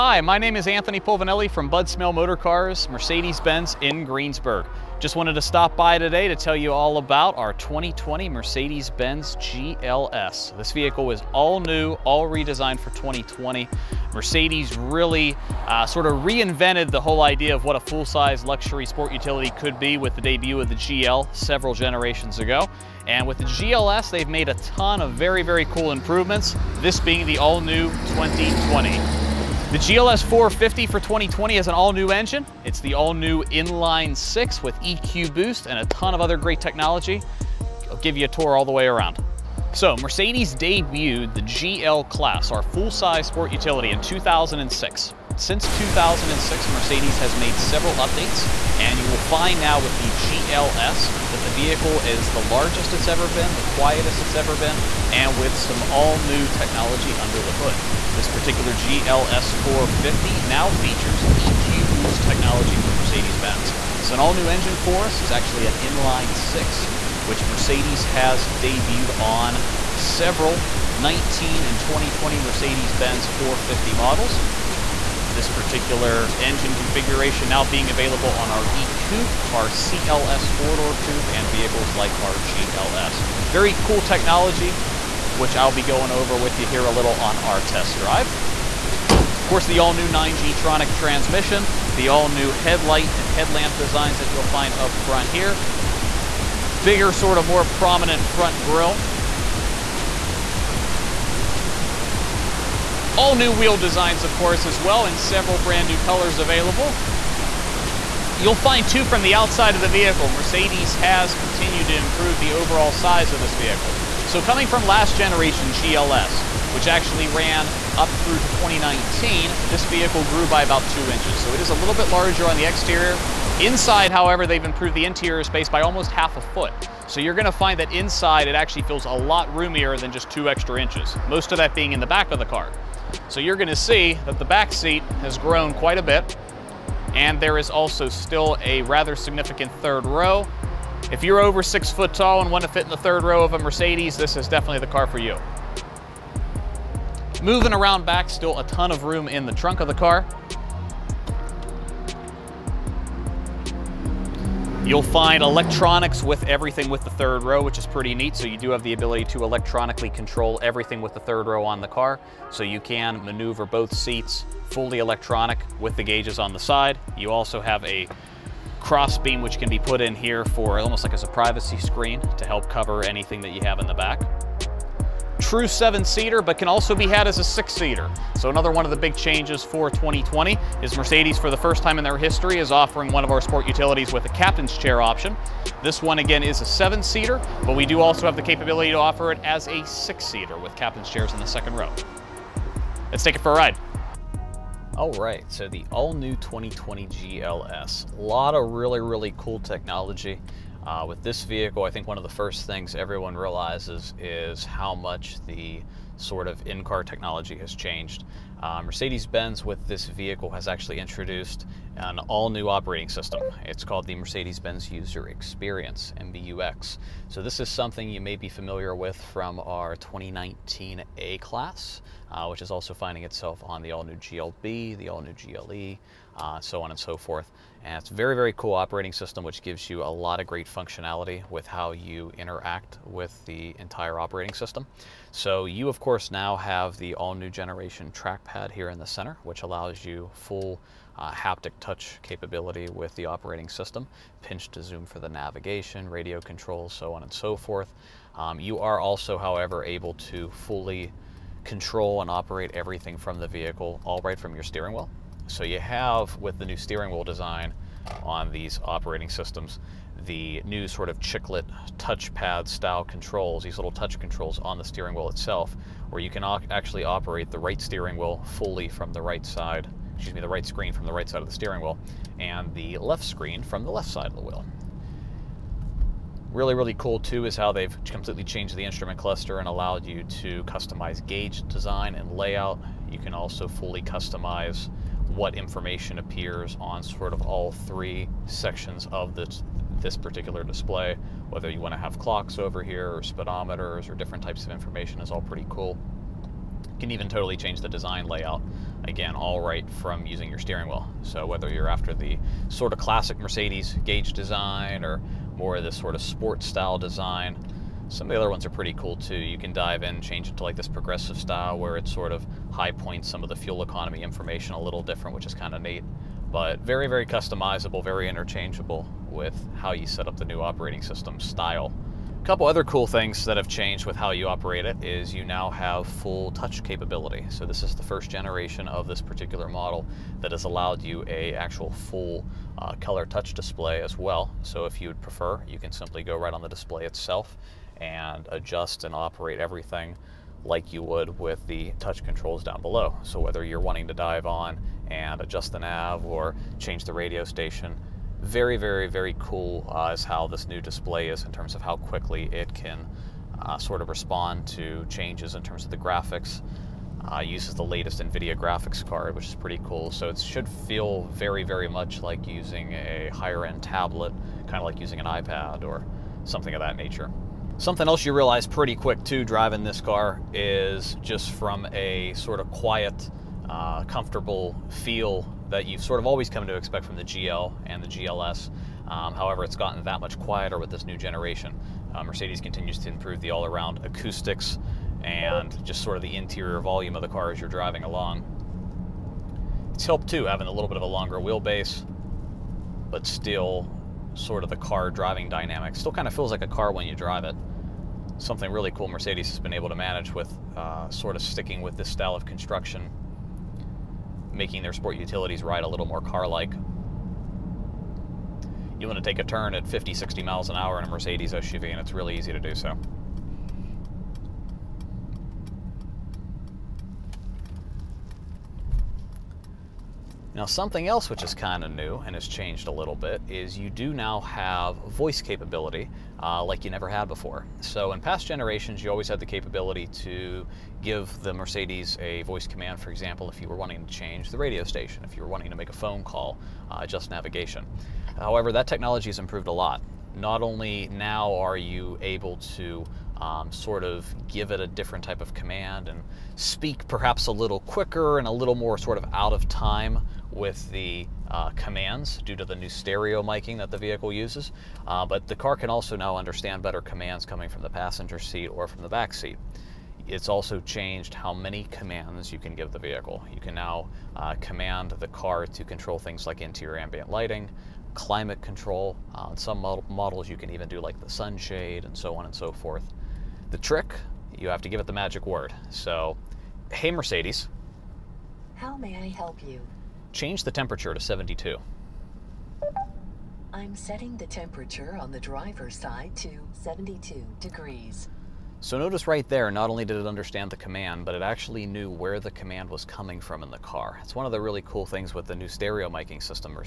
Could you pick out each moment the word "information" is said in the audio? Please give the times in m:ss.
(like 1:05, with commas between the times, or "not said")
4:45, 4:54, 5:14.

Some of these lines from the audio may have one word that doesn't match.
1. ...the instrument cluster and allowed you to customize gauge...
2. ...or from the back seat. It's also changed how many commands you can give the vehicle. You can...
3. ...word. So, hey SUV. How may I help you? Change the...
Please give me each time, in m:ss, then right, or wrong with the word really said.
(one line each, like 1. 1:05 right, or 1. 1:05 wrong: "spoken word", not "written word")
1. 4:38 right
2. 7:38 right
3. 7:55 wrong: "Mercedes", not "SUV".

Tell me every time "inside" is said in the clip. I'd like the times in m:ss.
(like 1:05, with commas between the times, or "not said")
2:03, 2:07.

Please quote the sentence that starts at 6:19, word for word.
Um, however, it's gotten that much quieter with this new generation.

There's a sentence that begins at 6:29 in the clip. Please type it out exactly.
It's helped too having a little bit of a longer wheelbase, but still sort of the car driving dynamic.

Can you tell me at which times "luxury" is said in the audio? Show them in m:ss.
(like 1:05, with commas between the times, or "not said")
0:18.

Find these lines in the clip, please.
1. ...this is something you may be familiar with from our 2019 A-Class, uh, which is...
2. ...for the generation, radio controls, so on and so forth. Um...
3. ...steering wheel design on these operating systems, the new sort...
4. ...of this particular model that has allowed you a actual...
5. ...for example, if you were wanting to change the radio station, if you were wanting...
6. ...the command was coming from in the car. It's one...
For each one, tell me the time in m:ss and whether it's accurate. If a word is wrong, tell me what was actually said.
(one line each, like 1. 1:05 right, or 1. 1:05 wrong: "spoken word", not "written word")
1. 3:37 right
2. 4:05 wrong: "navigation", not "generation"
3. 4:16 right
4. 5:28 right
5. 7:13 right
6. 8:12 right.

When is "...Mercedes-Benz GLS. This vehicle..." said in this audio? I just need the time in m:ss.
0:08.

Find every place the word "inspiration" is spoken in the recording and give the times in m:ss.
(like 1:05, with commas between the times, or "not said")
not said.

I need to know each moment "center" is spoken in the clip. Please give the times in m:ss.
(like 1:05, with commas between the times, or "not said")
3:59.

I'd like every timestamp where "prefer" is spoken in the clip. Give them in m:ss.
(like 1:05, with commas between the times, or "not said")
5:35.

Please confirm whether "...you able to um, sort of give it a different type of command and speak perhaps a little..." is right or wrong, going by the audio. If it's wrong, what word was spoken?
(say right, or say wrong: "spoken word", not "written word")
right.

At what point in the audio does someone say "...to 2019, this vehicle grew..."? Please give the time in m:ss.
1:58.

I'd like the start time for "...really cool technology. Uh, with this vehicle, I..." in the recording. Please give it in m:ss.
3:19.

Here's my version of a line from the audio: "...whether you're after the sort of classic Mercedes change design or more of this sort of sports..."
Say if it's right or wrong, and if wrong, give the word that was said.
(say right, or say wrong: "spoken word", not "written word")
wrong: "gauge", not "change".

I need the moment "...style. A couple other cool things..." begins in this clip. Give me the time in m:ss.
5:21.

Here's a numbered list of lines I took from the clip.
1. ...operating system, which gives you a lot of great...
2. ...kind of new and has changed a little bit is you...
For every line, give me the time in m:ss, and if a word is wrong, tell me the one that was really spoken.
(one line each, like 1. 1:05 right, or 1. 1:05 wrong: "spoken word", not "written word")
1. 3:48 right
2. 7:01 right.